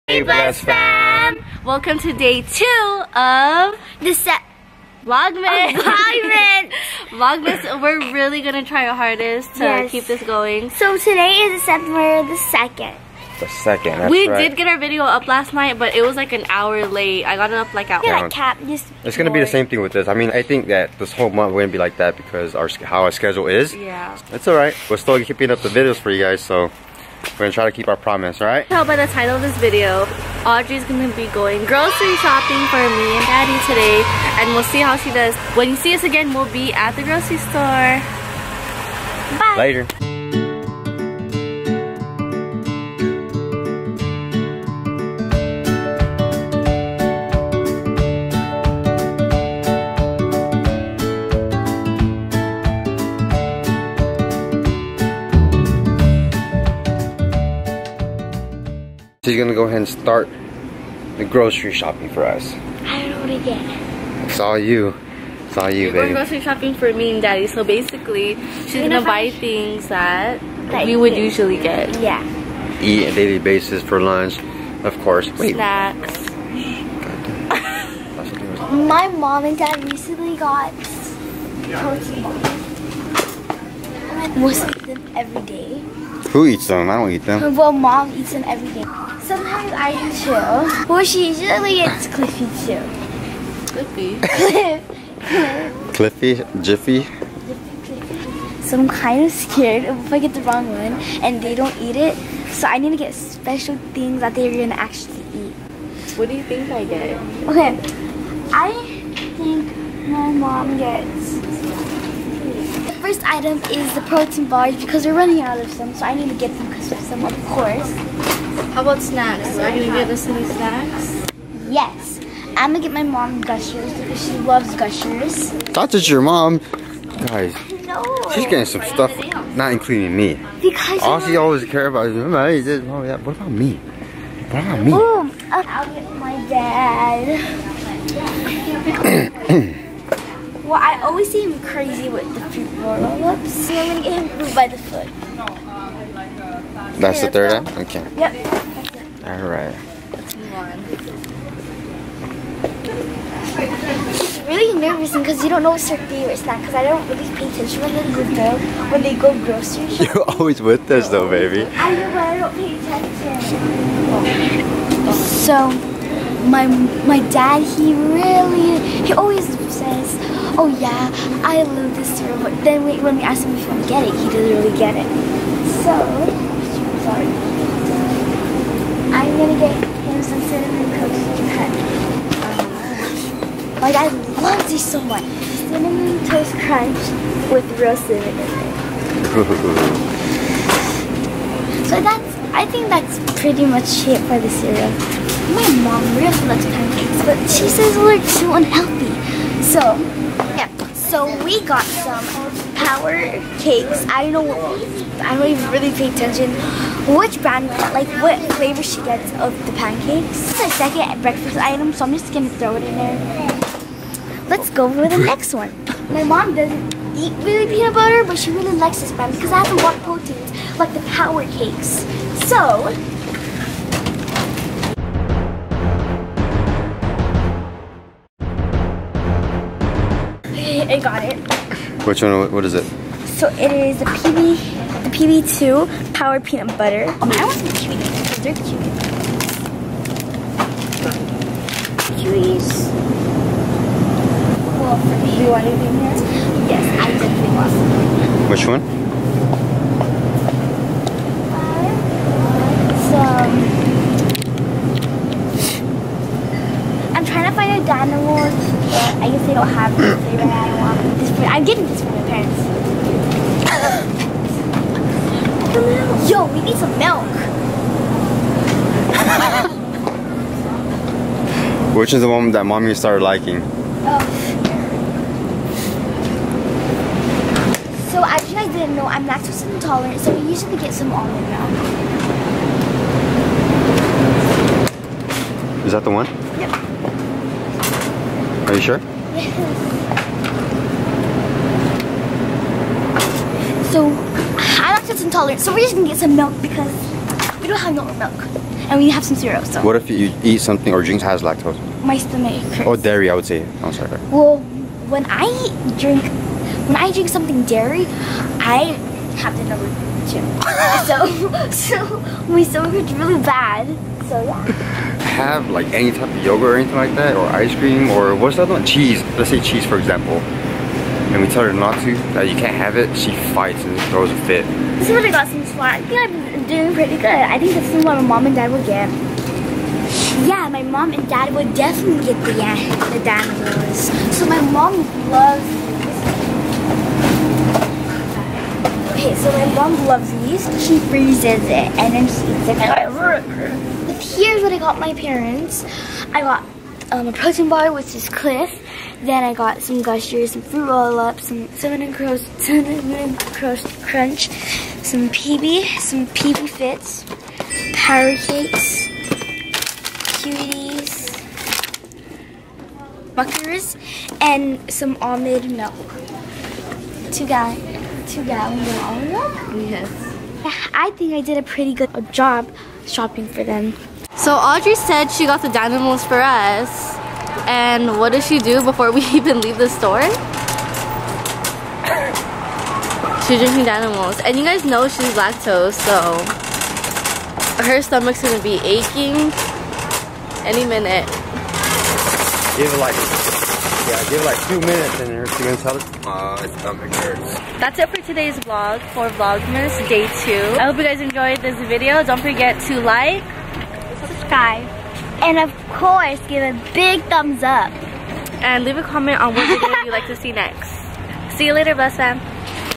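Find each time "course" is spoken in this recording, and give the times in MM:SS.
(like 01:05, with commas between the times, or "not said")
01:14, 01:57, 06:45.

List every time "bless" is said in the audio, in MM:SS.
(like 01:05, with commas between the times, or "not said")
00:00, 06:51.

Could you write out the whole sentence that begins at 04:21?
This, I'm getting this from my parents.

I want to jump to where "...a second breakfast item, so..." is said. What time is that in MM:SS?
03:30.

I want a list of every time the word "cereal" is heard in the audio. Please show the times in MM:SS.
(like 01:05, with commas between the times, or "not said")
02:52, 03:14, 04:59.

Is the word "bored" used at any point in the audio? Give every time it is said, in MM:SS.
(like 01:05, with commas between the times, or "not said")
00:19.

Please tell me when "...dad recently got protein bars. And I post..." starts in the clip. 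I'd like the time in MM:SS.
01:19.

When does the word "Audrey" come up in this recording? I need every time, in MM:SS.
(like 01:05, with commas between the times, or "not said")
00:30, 06:14.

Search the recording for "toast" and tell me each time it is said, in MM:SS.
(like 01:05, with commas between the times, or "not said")
03:00, 03:06.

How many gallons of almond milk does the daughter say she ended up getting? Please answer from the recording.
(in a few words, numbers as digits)
2.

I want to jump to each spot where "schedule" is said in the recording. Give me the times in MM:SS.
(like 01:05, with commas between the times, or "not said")
00:23.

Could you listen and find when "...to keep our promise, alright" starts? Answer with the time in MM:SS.
00:27.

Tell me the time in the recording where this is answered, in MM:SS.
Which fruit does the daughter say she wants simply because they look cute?
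03:57.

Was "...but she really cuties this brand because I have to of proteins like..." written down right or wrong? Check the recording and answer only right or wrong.
wrong.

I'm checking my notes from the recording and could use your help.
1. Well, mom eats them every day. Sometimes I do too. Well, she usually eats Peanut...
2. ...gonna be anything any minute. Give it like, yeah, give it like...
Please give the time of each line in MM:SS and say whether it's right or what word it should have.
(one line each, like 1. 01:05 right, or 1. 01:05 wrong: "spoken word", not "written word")
1. 01:27 wrong: "Cliffy", not "Peanut"
2. 06:28 wrong: "aching", not "anything".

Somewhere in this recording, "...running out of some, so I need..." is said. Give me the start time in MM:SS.
01:55.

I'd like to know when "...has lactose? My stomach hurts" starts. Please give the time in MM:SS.
05:01.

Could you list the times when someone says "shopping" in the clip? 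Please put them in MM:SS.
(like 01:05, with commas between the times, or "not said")
00:32, 01:01, 01:06, 02:39, 06:13.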